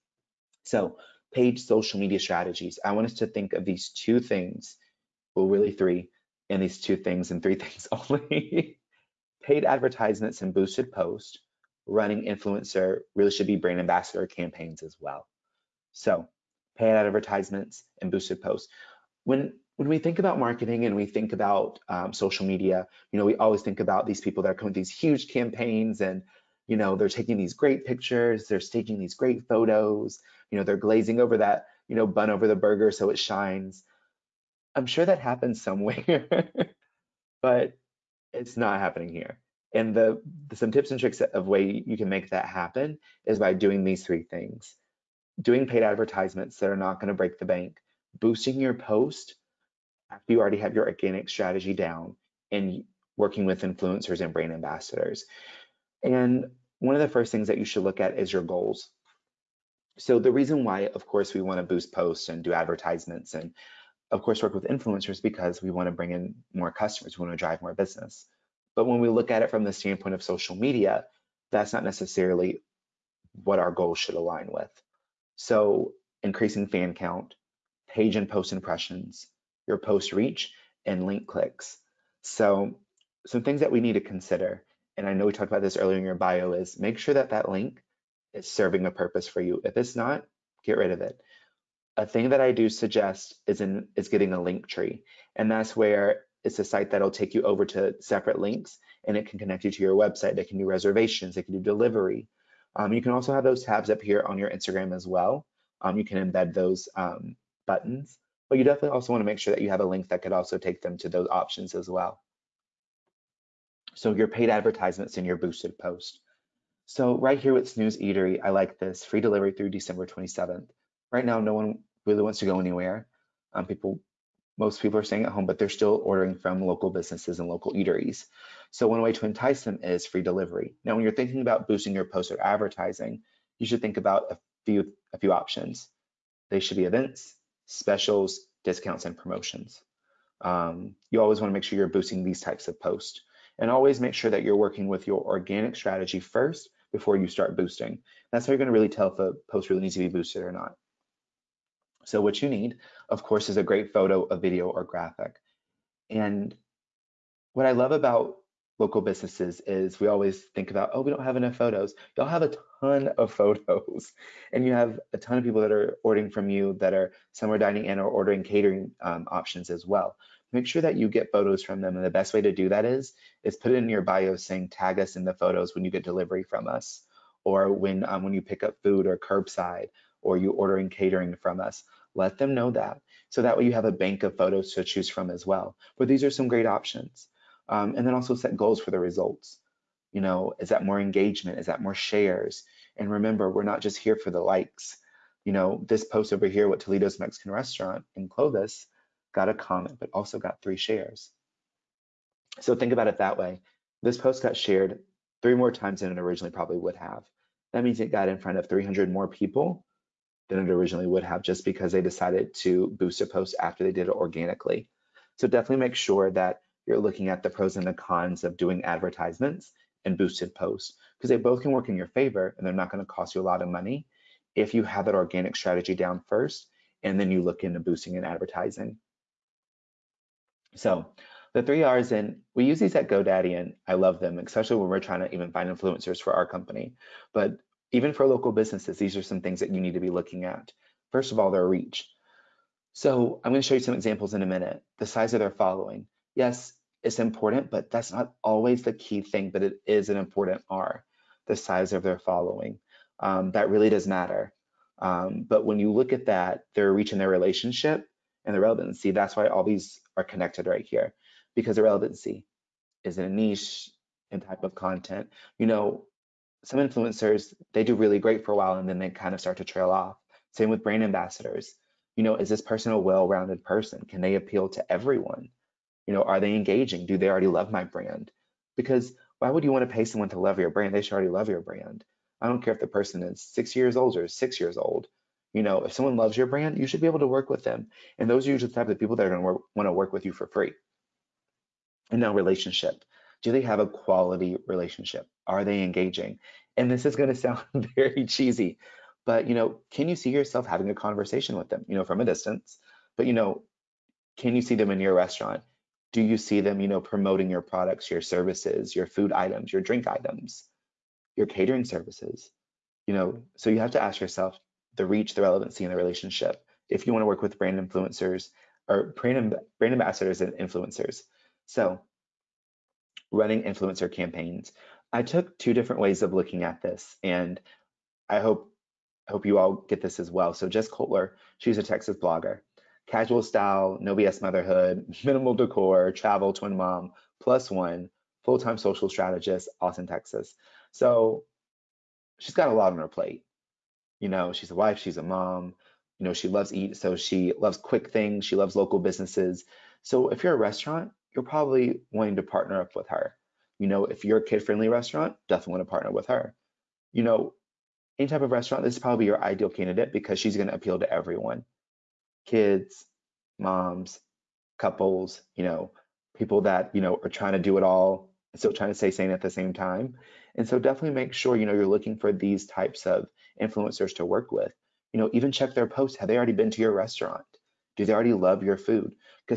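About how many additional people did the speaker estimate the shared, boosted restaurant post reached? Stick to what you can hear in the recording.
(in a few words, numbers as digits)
300.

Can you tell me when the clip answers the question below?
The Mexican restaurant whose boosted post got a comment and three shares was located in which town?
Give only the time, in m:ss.
3:18.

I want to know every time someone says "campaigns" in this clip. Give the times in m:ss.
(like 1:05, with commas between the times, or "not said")
0:14, 0:25, 5:24.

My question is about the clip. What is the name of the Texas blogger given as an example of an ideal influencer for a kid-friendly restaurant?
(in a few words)
Jess Kotler.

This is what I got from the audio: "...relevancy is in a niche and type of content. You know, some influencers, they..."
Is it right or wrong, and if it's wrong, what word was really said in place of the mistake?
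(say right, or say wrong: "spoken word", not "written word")
right.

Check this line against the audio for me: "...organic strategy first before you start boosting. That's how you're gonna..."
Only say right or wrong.
right.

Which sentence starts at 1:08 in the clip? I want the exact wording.
But when we look at it from the standpoint of social media, that's not necessarily what our goals should align with.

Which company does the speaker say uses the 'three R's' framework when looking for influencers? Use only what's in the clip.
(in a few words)
GoDaddy.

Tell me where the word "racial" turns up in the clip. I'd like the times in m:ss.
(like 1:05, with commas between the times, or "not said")
not said.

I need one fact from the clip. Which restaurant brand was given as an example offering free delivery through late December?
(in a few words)
Snooze Eatery.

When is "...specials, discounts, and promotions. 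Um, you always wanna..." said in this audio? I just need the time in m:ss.
2:17.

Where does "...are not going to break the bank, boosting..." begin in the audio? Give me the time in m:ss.
0:46.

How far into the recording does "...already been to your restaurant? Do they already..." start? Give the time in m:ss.
6:16.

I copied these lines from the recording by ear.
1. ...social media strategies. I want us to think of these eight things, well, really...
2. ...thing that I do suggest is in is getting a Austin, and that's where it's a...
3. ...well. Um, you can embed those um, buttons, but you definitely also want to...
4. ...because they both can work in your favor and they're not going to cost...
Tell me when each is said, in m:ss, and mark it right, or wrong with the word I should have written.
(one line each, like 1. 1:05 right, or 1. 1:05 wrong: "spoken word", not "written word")
1. 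0:01 wrong: "two", not "eight"
2. 1:32 wrong: "Linktree", not "Austin"
3. 1:45 right
4. 3:41 right.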